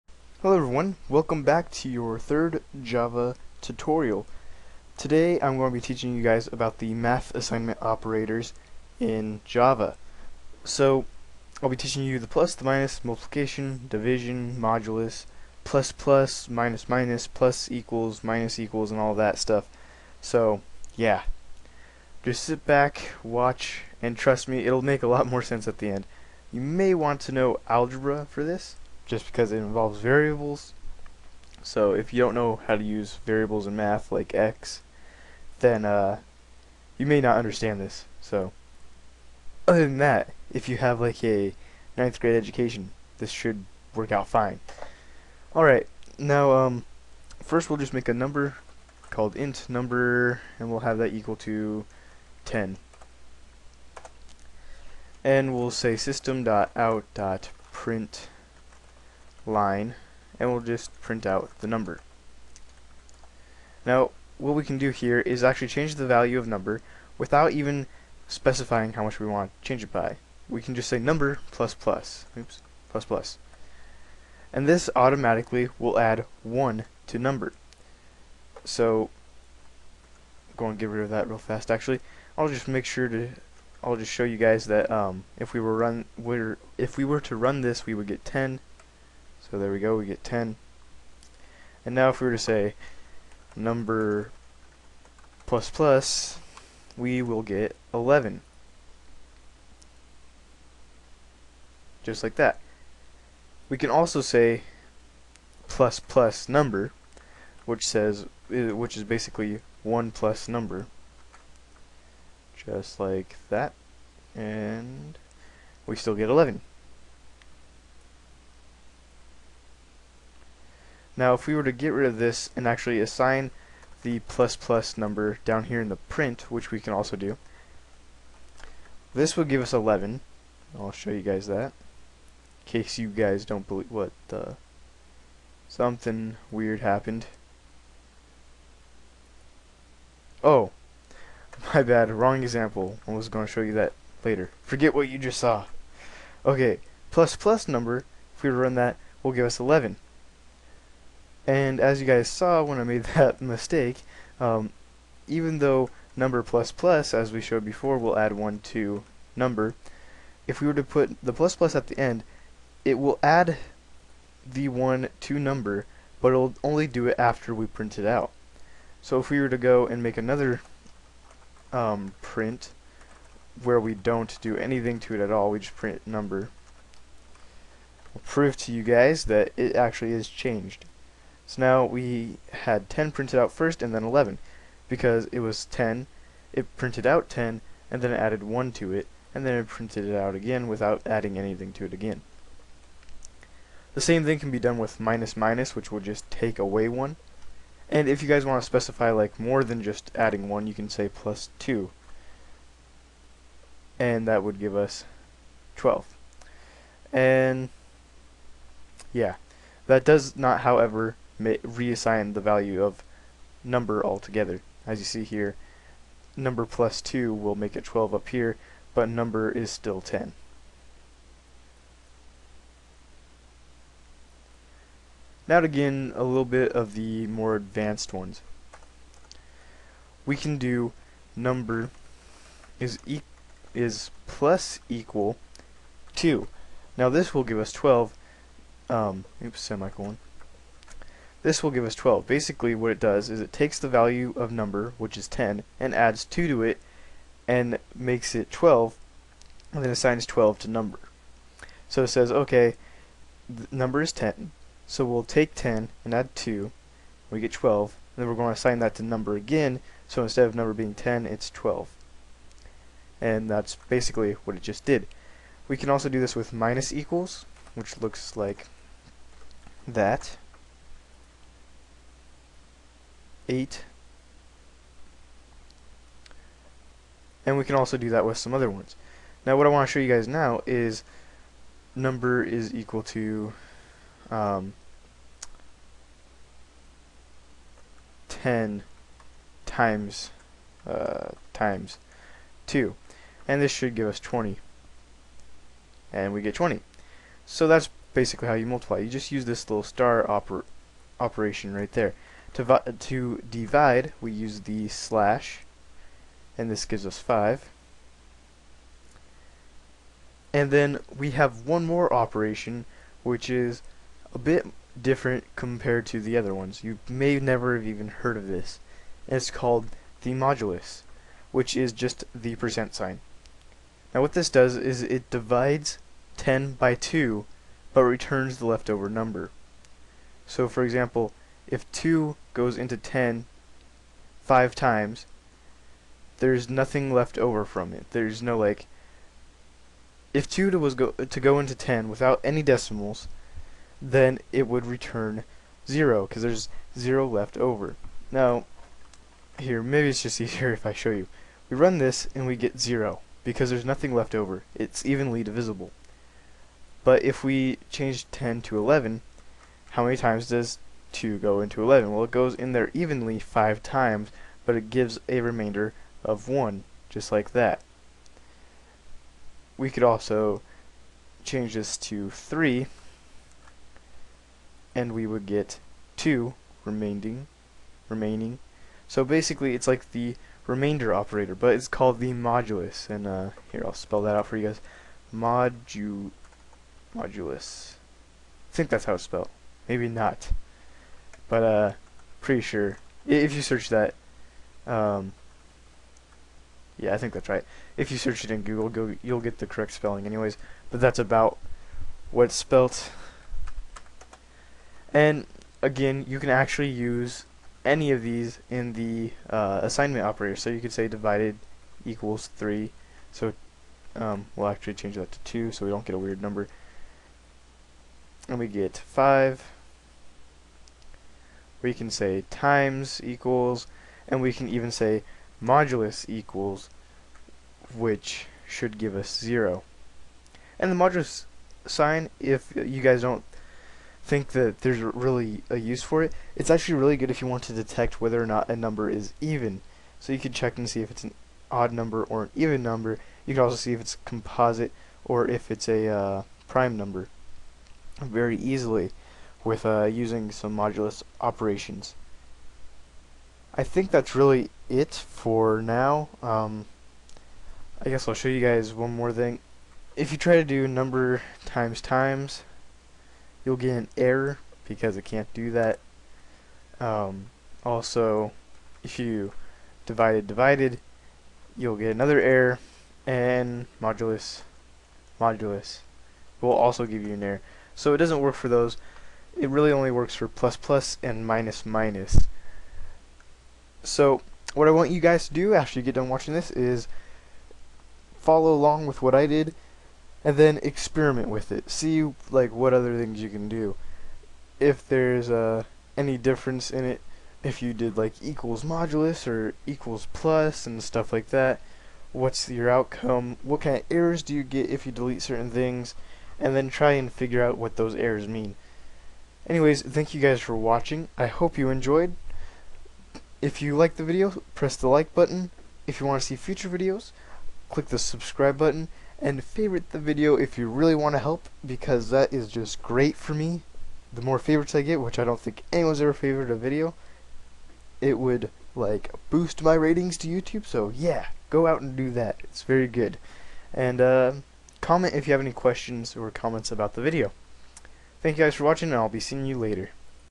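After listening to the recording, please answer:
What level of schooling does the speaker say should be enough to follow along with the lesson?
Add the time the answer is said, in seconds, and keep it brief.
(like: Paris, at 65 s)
Ninth grade, at 41 s.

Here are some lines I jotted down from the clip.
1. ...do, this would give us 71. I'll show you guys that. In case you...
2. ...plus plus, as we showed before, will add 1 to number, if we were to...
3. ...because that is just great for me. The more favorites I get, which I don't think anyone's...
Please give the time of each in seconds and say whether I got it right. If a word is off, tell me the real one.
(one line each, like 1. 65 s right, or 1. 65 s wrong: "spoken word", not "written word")
1. 127 s wrong: "11", not "71"
2. 156 s right
3. 521 s right.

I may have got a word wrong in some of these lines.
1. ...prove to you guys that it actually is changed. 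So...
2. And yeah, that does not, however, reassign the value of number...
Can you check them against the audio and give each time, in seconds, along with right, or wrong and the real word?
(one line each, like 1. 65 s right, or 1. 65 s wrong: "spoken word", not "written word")
1. 178 s right
2. 207 s right.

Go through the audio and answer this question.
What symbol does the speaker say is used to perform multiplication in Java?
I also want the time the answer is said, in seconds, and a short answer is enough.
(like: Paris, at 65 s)
Star, at 299 s.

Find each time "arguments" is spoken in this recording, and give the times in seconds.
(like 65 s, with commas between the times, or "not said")
not said.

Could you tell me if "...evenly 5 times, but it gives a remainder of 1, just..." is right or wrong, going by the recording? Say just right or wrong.
right.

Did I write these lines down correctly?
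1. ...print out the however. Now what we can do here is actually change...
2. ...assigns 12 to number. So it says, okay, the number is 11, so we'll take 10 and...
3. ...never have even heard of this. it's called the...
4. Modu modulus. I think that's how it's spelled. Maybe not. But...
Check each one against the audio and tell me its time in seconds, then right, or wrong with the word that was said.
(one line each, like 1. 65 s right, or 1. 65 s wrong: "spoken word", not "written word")
1. 61 s wrong: "number", not "however"
2. 249 s wrong: "10", not "11"
3. 317 s right
4. 385 s right.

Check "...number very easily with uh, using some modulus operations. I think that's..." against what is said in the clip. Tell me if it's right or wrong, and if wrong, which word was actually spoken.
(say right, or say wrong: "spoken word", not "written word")
right.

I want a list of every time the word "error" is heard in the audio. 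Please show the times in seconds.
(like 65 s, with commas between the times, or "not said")
464 s, 472 s, 477 s, 504 s, 508 s.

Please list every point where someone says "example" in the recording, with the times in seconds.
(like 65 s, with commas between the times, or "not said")
142 s, 330 s.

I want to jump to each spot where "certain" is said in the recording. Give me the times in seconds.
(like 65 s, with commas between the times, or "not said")
505 s.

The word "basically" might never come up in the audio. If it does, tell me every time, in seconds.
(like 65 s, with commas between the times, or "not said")
109 s, 242 s, 263 s, 298 s, 379 s.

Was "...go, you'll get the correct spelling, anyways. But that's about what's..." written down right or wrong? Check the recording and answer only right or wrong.
right.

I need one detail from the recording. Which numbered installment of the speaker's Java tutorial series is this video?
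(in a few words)
Third.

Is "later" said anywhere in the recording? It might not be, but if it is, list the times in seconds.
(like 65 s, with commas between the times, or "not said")
144 s, 539 s.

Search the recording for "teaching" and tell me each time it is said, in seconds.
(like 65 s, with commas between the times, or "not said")
5 s, 11 s.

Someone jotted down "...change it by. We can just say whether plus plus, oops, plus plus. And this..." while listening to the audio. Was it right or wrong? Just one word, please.
wrong.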